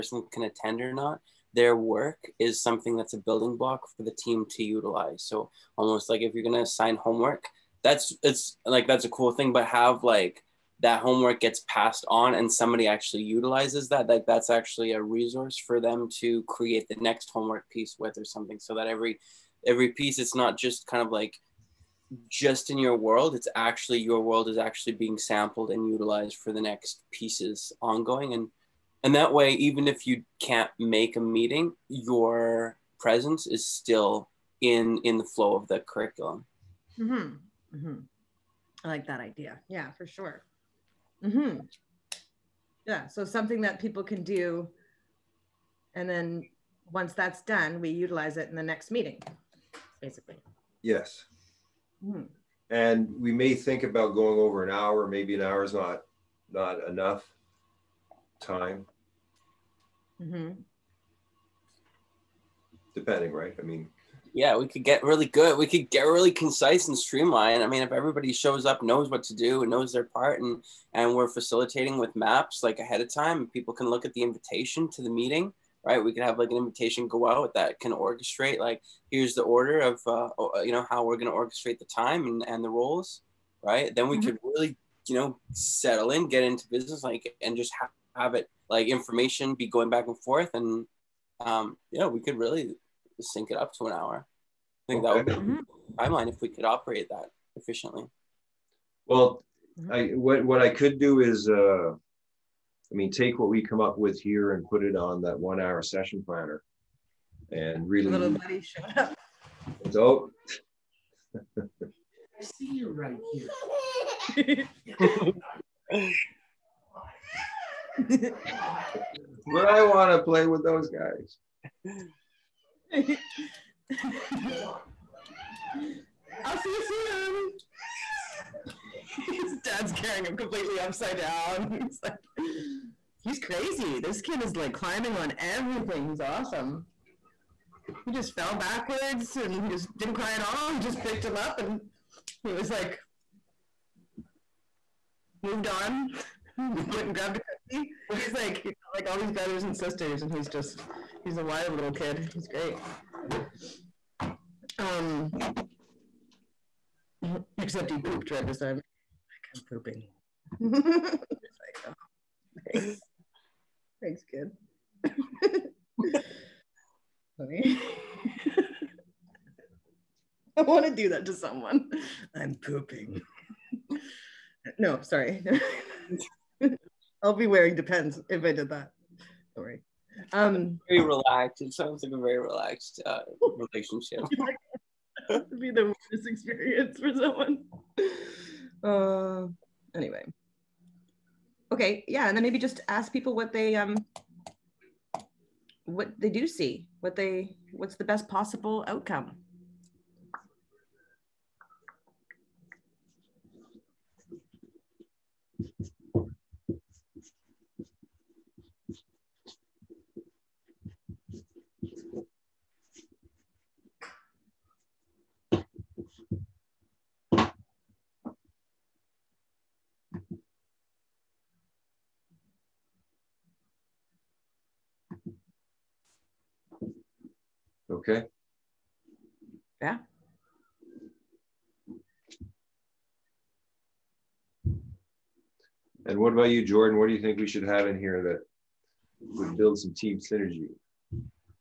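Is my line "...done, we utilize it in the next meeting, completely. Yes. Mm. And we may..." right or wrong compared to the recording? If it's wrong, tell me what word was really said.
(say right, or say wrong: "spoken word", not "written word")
wrong: "basically", not "completely".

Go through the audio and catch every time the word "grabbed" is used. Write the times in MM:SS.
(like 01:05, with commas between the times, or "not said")
02:27.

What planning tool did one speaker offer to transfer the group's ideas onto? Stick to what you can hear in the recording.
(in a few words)
one hour session planner.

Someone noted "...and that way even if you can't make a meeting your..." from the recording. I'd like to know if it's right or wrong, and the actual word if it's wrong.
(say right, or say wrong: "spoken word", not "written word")
right.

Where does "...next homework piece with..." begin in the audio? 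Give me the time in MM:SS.
00:16.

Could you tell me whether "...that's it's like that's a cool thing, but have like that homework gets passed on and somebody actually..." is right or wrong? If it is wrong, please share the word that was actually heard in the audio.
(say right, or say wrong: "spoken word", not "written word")
right.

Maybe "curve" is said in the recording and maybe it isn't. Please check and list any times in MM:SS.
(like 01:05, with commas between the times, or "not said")
not said.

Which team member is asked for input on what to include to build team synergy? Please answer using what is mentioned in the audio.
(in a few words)
Jordin.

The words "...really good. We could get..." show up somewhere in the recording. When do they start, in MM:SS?
01:05.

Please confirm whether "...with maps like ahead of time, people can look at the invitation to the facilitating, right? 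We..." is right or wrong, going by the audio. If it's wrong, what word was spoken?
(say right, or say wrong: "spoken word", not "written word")
wrong: "meeting", not "facilitating".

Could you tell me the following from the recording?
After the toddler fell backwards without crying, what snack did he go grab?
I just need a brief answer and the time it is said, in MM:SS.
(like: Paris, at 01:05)
a cookie, at 02:27.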